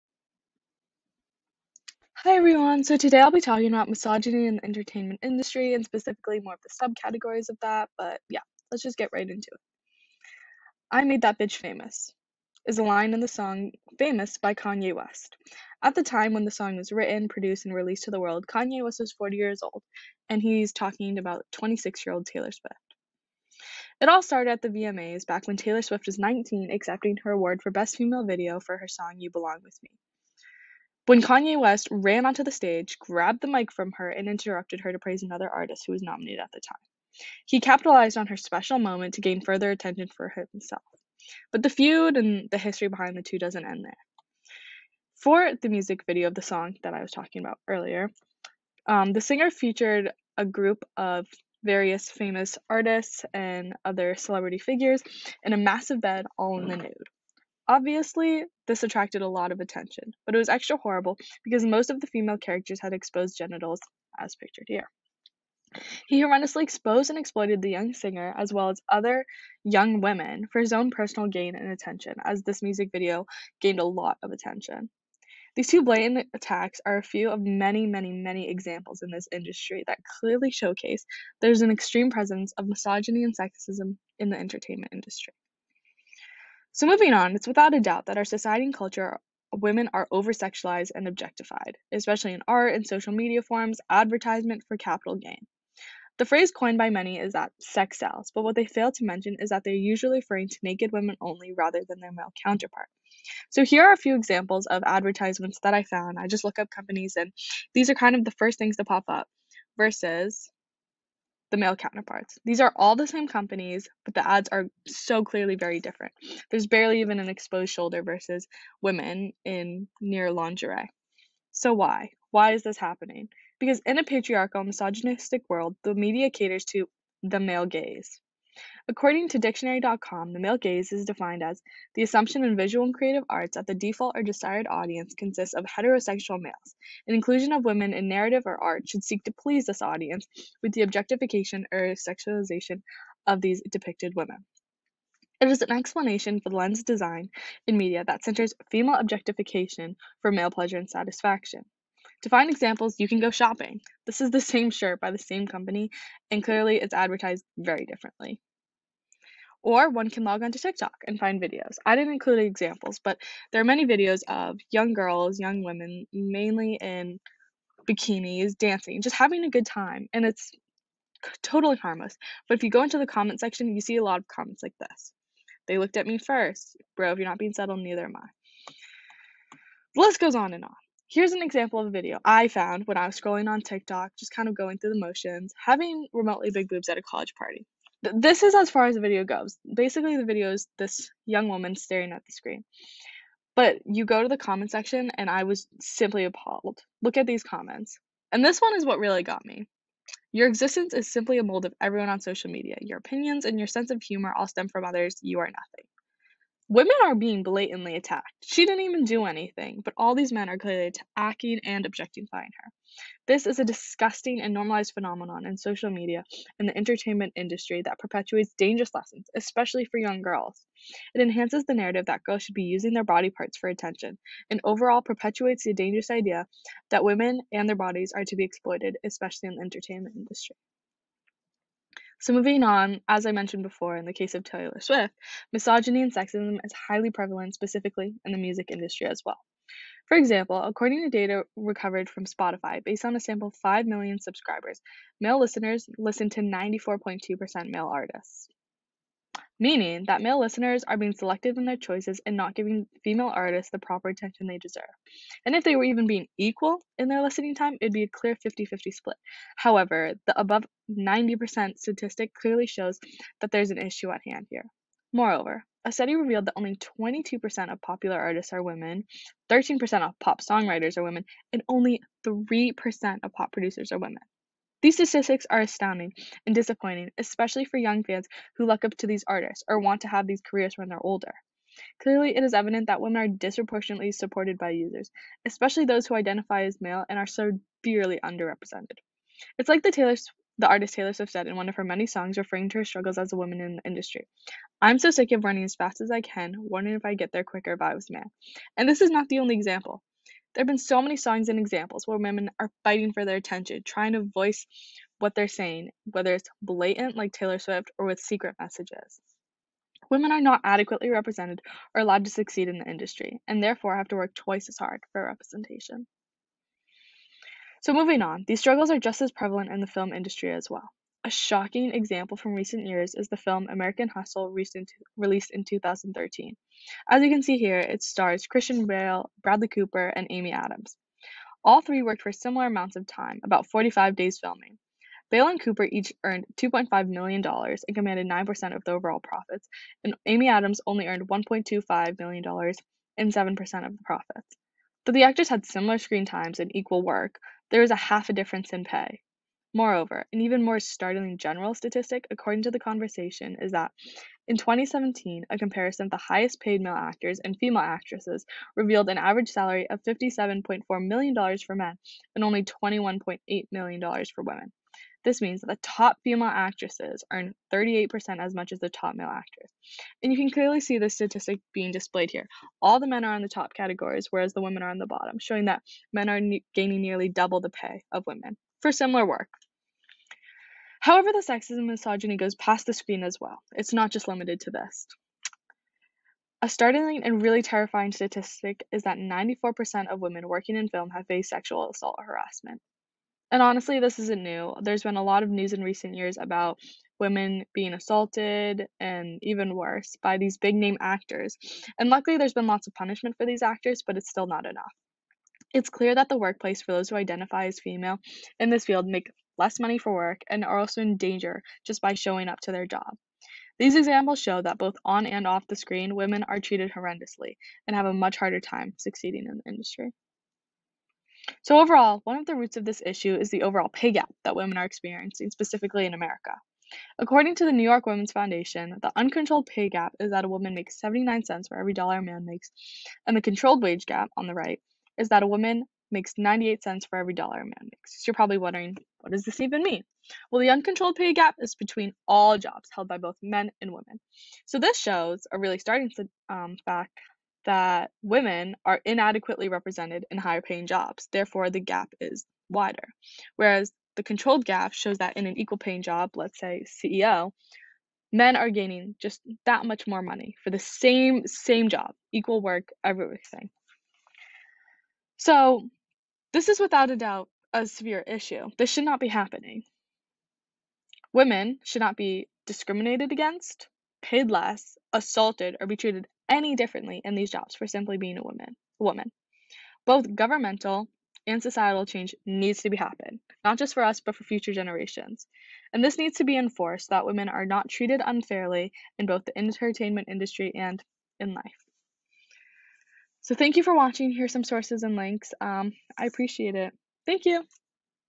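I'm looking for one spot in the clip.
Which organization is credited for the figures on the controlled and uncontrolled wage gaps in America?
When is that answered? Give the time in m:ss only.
7:07.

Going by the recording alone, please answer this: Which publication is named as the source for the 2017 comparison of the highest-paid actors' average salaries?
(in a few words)
The Conversation.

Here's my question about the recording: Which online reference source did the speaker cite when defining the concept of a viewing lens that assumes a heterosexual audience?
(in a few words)
Dictionary.com.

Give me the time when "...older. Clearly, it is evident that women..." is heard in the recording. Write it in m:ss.
4:41.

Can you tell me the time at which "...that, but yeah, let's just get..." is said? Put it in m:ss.
0:07.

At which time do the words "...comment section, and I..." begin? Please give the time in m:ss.
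3:14.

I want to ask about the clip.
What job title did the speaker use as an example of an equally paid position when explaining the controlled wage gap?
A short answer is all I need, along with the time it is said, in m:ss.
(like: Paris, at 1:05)
CEO, at 7:36.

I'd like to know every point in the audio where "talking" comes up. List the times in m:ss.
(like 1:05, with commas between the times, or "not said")
0:03, 0:20, 0:47.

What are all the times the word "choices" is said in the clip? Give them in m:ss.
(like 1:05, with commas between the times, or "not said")
4:11.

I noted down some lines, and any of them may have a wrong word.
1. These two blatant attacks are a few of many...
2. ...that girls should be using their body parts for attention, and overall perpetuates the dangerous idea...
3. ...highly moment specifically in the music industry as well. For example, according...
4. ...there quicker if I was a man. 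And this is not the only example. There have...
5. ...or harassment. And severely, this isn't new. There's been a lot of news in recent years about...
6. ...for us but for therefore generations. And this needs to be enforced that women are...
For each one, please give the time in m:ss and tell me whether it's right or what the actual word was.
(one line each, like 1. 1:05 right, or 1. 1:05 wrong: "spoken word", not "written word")
1. 1:15 right
2. 3:42 right
3. 3:56 wrong: "prevalent", not "moment"
4. 4:57 right
5. 6:32 wrong: "honestly", not "severely"
6. 8:03 wrong: "future", not "therefore".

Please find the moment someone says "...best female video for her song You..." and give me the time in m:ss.
0:27.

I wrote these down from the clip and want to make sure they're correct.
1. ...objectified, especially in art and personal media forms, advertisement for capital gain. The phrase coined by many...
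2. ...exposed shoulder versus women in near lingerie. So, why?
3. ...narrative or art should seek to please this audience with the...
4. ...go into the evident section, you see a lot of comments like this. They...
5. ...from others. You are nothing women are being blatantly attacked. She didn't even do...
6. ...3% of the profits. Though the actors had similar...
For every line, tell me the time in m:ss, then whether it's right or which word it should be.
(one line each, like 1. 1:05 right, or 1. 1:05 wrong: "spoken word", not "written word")
1. 1:31 wrong: "social", not "personal"
2. 1:57 right
3. 2:18 right
4. 2:52 wrong: "comment", not "evident"
5. 3:24 right
6. 5:43 wrong: "7", not "3".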